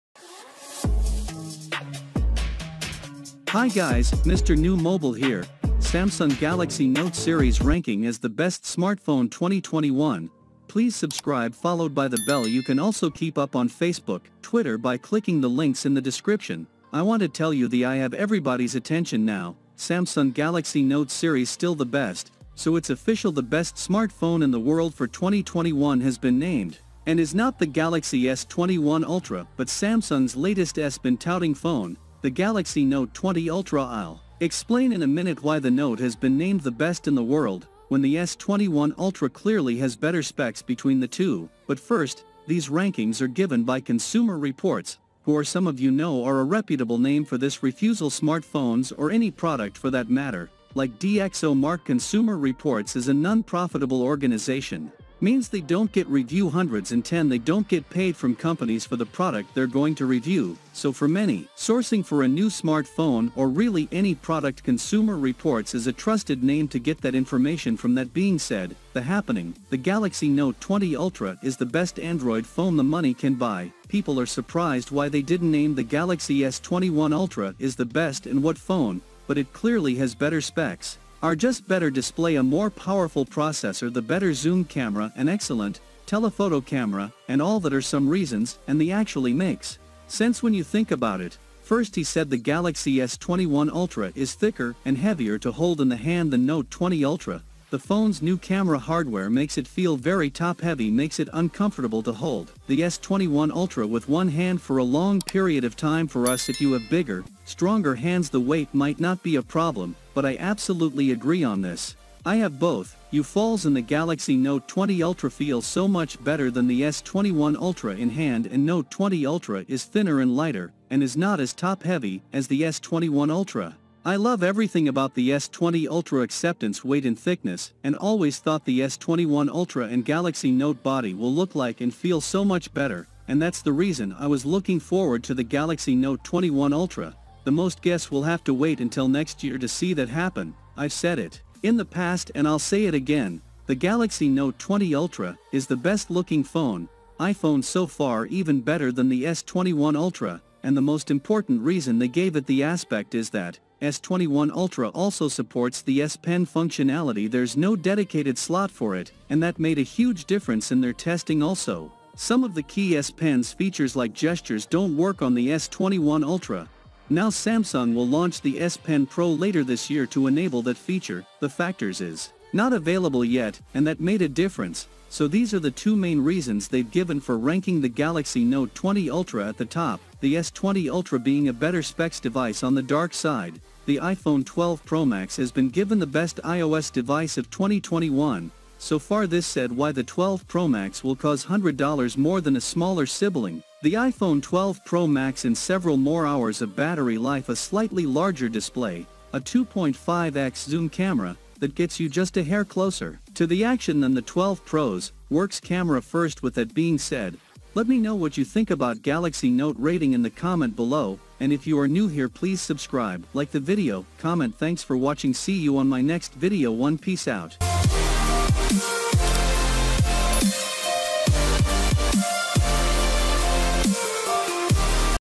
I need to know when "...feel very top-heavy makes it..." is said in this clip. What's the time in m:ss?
1:39.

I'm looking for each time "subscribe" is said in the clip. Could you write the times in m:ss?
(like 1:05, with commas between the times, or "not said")
0:10, 3:32.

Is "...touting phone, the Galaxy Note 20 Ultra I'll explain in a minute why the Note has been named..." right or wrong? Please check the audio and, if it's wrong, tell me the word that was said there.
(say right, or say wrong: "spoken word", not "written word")
right.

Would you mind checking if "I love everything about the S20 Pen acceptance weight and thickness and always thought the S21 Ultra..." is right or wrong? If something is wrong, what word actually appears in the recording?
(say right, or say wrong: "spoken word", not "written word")
wrong: "Ultra", not "Pen".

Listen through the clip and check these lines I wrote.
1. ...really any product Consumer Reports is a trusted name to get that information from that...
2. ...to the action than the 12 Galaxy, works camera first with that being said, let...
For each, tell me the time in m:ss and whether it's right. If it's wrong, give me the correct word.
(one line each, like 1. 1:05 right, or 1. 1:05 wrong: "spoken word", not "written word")
1. 1:03 right
2. 3:23 wrong: "Pros", not "Galaxy".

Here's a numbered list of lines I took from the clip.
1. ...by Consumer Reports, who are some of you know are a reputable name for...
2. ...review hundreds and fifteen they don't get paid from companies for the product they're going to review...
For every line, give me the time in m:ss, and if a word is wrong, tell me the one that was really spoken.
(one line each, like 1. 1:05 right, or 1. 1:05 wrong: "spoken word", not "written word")
1. 0:43 right
2. 0:56 wrong: "ten", not "fifteen".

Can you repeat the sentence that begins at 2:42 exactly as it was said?
Some of the key S Pen's features like gestures don't work on the S21 Ultra.